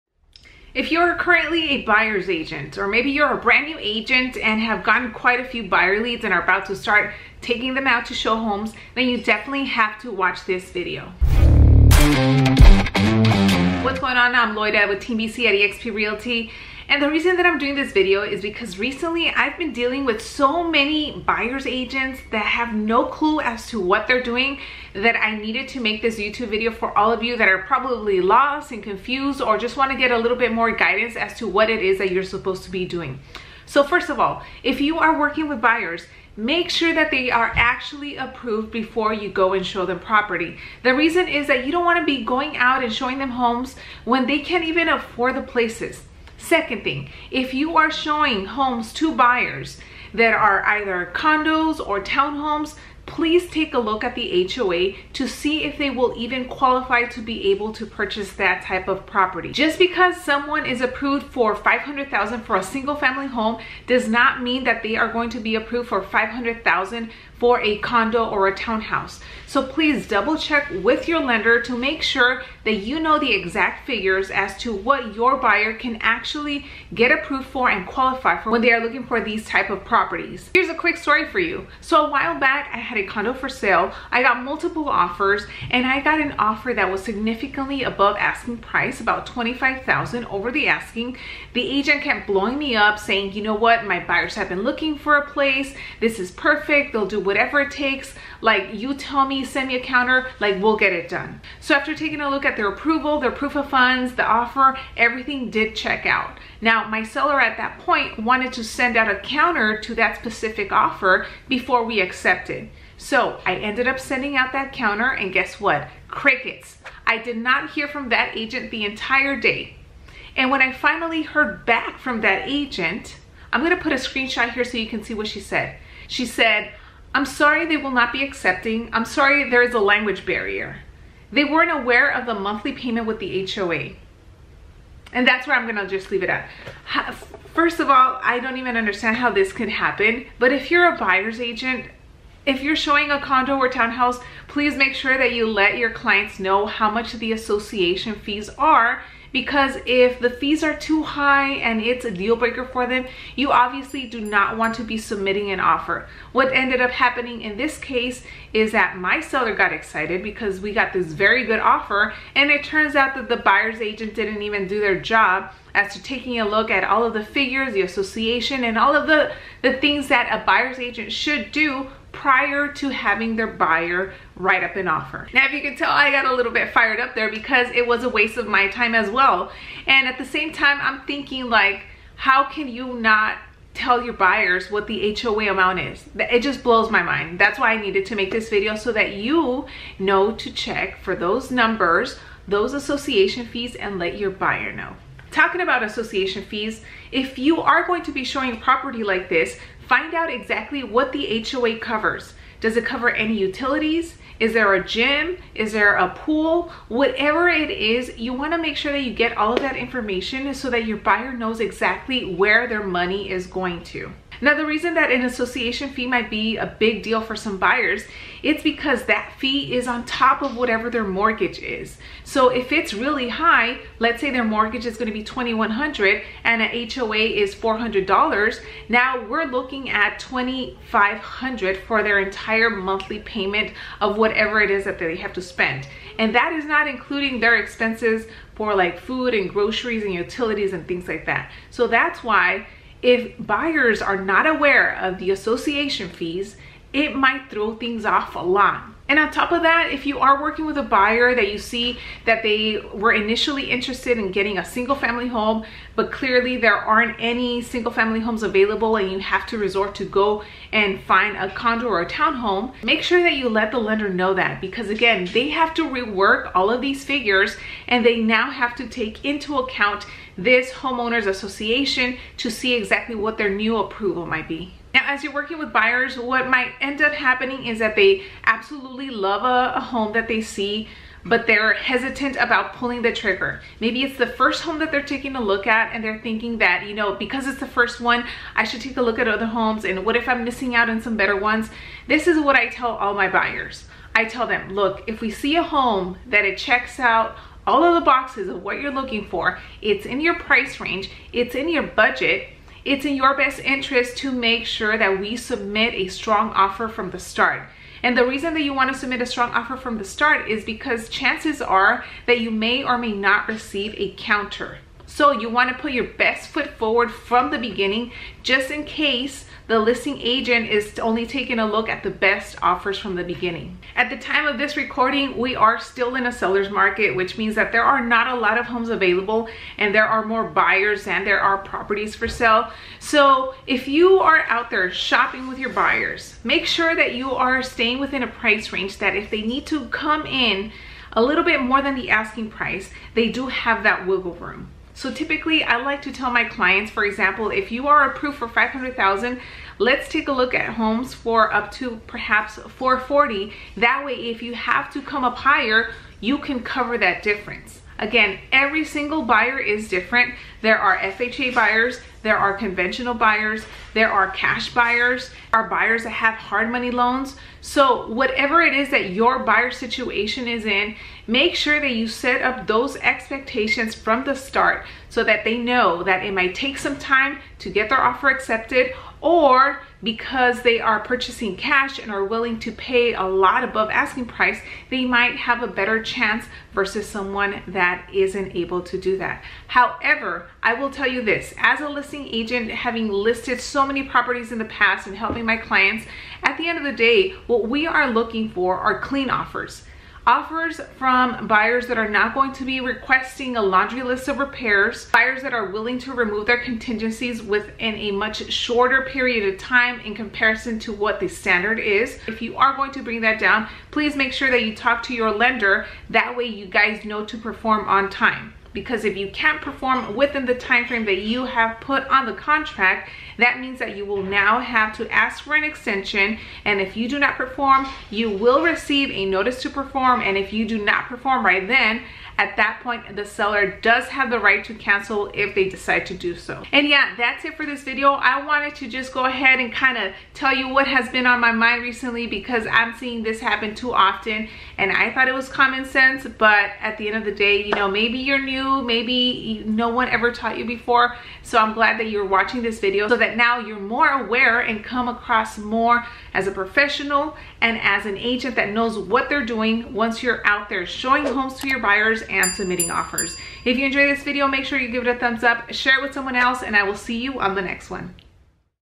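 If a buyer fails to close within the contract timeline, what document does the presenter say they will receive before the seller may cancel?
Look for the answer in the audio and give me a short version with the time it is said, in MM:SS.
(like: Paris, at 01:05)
notice to perform, at 07:09.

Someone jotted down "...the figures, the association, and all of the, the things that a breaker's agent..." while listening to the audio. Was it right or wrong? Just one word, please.
wrong.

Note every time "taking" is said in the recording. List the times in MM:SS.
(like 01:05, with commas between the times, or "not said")
00:07, 01:41, 02:46, 04:45, 05:21.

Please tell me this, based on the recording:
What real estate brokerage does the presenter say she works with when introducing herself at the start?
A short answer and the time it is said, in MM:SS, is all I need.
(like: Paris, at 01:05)
eXp Realty, at 00:15.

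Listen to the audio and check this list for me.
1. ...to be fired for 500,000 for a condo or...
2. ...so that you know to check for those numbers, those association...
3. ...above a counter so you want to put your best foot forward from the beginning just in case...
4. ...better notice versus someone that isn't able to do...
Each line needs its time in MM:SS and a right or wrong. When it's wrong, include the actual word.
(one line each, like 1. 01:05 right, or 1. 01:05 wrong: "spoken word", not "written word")
1. 01:05 wrong: "approved", not "fired"
2. 03:08 right
3. 05:13 wrong: "receive", not "above"
4. 06:25 wrong: "chance", not "notice".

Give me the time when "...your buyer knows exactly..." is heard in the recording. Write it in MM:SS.
03:30.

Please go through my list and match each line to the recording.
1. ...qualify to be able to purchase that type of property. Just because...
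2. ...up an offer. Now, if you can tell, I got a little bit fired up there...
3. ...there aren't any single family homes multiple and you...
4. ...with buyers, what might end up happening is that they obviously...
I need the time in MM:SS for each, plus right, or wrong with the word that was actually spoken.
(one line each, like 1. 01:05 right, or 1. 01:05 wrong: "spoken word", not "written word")
1. 00:56 right
2. 02:54 right
3. 04:16 wrong: "available", not "multiple"
4. 04:35 wrong: "absolutely", not "obviously".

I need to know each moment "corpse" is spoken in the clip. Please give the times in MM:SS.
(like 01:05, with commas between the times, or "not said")
not said.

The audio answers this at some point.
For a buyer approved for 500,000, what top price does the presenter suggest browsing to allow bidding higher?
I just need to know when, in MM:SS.
05:52.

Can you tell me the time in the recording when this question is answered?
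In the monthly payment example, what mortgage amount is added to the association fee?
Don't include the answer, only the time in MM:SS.
03:45.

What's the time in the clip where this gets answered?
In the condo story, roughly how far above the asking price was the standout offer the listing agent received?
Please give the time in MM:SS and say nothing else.
01:29.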